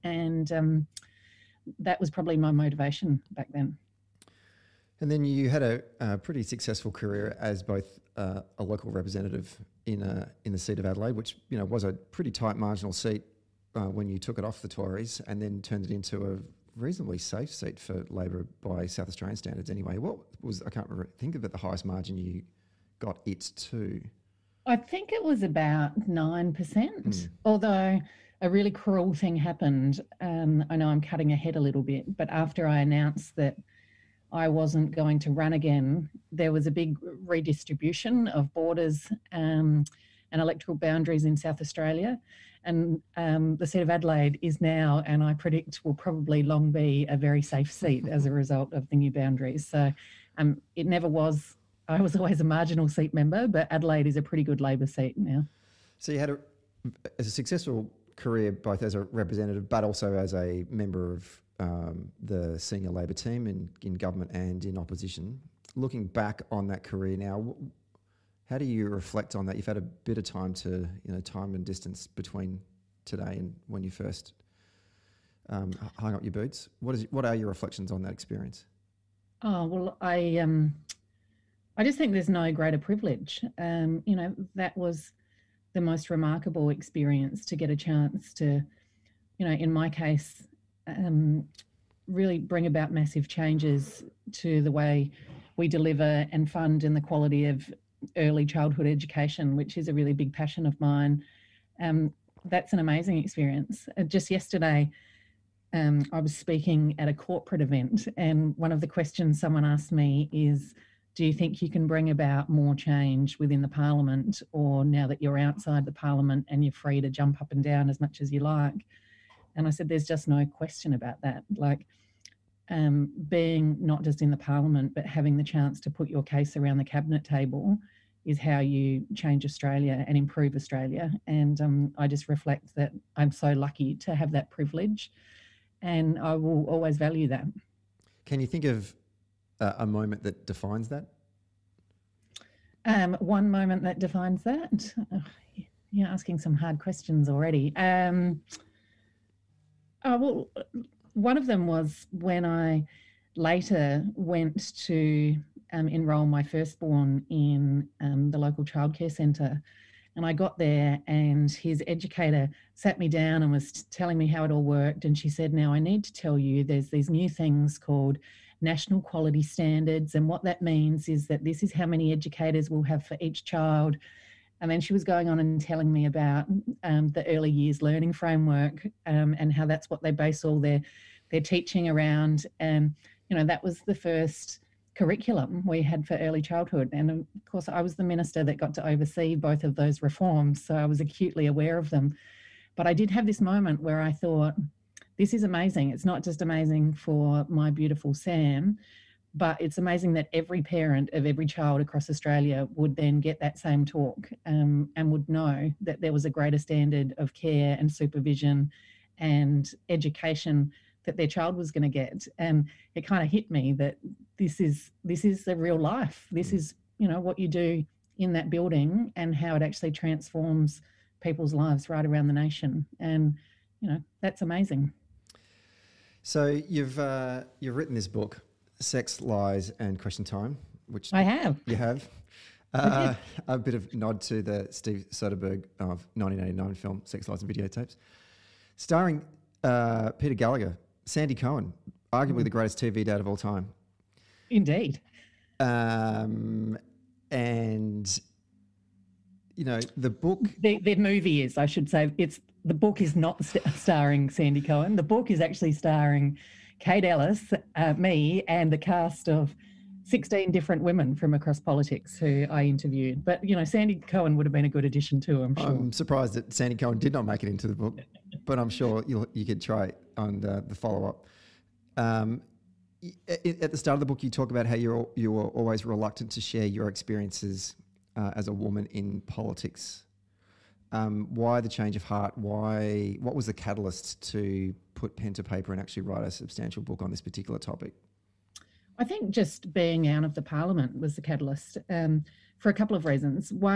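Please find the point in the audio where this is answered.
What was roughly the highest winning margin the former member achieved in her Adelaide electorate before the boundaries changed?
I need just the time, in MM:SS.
00:26.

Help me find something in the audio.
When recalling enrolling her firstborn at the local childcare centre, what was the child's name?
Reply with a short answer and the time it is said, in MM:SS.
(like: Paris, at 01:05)
Sam, at 03:18.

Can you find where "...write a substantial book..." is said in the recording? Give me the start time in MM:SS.
04:46.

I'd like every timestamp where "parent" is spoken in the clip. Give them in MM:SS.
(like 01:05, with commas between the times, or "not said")
03:20.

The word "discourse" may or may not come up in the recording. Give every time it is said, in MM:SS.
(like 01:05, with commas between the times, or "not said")
not said.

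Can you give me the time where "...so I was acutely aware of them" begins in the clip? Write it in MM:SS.
03:10.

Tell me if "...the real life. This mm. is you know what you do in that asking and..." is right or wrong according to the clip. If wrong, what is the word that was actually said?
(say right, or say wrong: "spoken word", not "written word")
wrong: "building", not "asking".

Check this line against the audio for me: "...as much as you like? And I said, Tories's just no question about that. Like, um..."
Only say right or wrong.
wrong.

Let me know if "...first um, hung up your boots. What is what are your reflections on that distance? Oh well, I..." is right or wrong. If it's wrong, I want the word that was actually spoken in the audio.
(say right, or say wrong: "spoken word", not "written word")
wrong: "experience", not "distance".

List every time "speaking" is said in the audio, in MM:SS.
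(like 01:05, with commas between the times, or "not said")
01:46.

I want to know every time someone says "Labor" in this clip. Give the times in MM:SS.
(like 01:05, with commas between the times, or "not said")
00:18, 00:54, 01:02.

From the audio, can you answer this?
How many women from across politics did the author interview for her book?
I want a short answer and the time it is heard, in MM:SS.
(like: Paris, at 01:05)
16, at 04:20.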